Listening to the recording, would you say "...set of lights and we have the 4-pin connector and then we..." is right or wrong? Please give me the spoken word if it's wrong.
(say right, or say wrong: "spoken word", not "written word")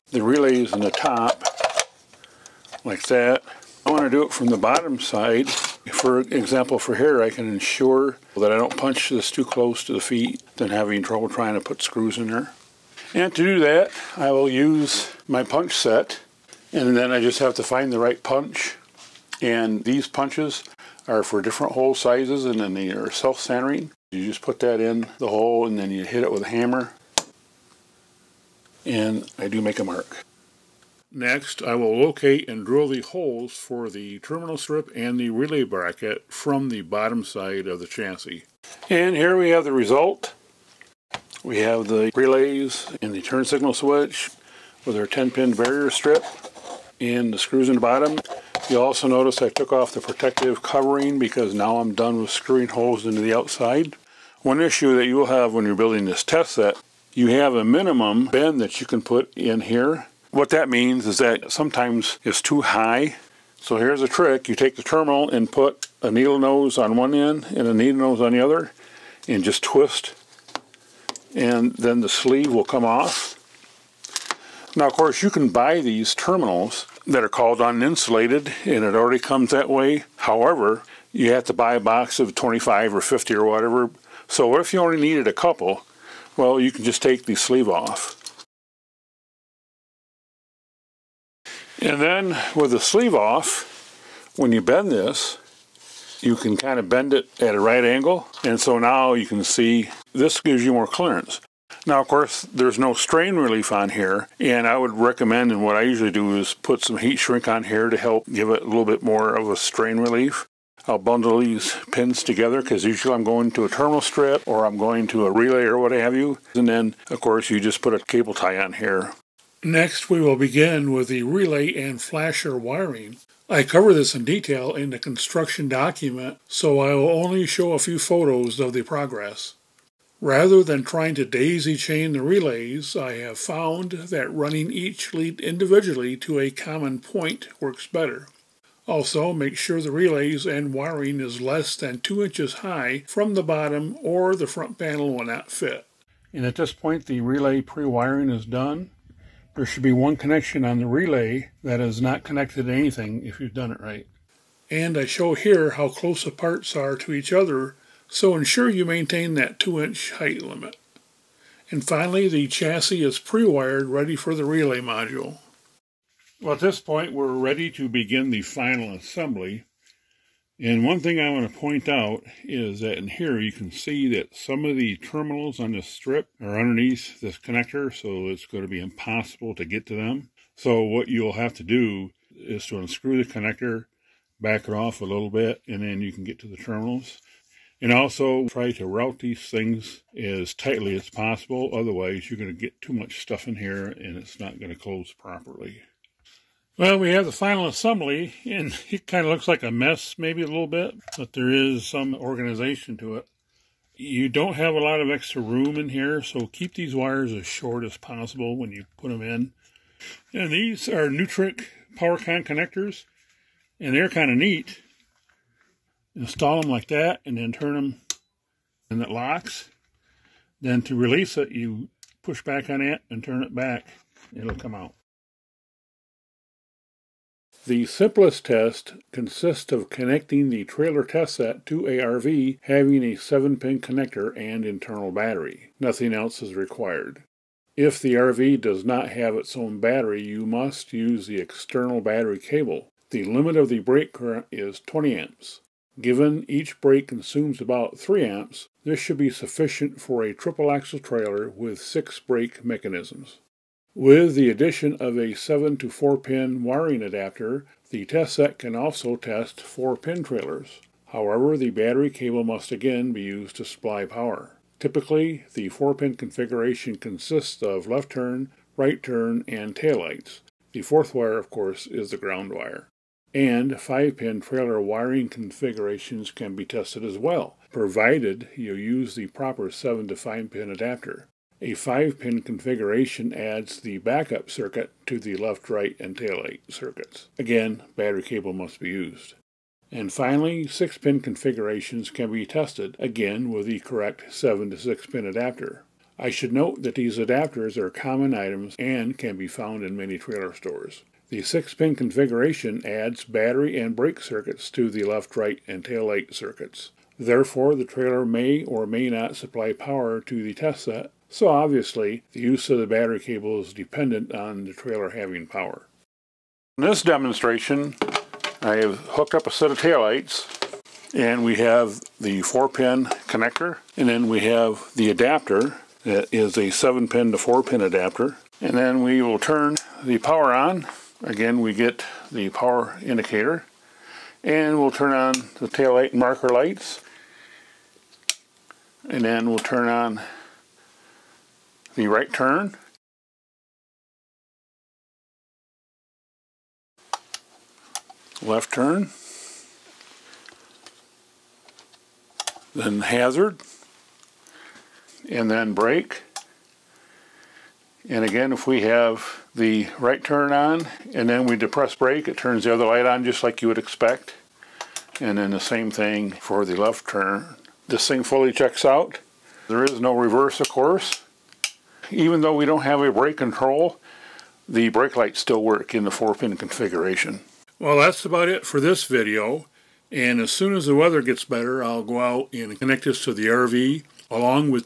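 wrong: "taillights", not "lights".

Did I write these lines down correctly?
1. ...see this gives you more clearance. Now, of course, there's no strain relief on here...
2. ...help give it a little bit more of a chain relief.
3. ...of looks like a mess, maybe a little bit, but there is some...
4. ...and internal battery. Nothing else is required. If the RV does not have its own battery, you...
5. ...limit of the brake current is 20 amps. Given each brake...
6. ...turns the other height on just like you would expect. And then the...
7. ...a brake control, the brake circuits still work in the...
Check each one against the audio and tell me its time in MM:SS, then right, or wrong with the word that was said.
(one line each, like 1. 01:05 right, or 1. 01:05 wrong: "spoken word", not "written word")
1. 01:39 right
2. 01:47 wrong: "strain", not "chain"
3. 03:19 right
4. 03:54 right
5. 04:03 right
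6. 06:02 wrong: "light", not "height"
7. 06:13 wrong: "lights", not "circuits".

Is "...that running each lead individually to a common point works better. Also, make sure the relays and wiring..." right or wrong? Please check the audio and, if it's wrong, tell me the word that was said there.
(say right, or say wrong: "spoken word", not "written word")
right.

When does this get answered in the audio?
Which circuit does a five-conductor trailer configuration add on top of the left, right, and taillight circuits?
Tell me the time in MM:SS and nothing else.
04:43.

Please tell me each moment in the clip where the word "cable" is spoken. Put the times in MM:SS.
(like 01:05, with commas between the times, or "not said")
01:57, 04:02, 04:22, 04:48, 05:13.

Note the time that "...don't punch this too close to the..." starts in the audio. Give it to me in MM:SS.
00:08.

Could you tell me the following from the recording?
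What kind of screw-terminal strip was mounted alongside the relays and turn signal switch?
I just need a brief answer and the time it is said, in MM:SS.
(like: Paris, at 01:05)
10-pin barrier strip, at 00:45.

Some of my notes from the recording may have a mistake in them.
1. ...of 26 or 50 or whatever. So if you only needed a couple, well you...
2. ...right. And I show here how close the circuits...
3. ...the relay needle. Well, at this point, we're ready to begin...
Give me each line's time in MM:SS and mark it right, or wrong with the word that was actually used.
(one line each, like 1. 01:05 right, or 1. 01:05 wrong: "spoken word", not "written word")
1. 01:22 wrong: "25", not "26"
2. 02:33 wrong: "parts", not "circuits"
3. 02:44 wrong: "module", not "needle".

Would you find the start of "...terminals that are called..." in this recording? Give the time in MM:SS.
01:16.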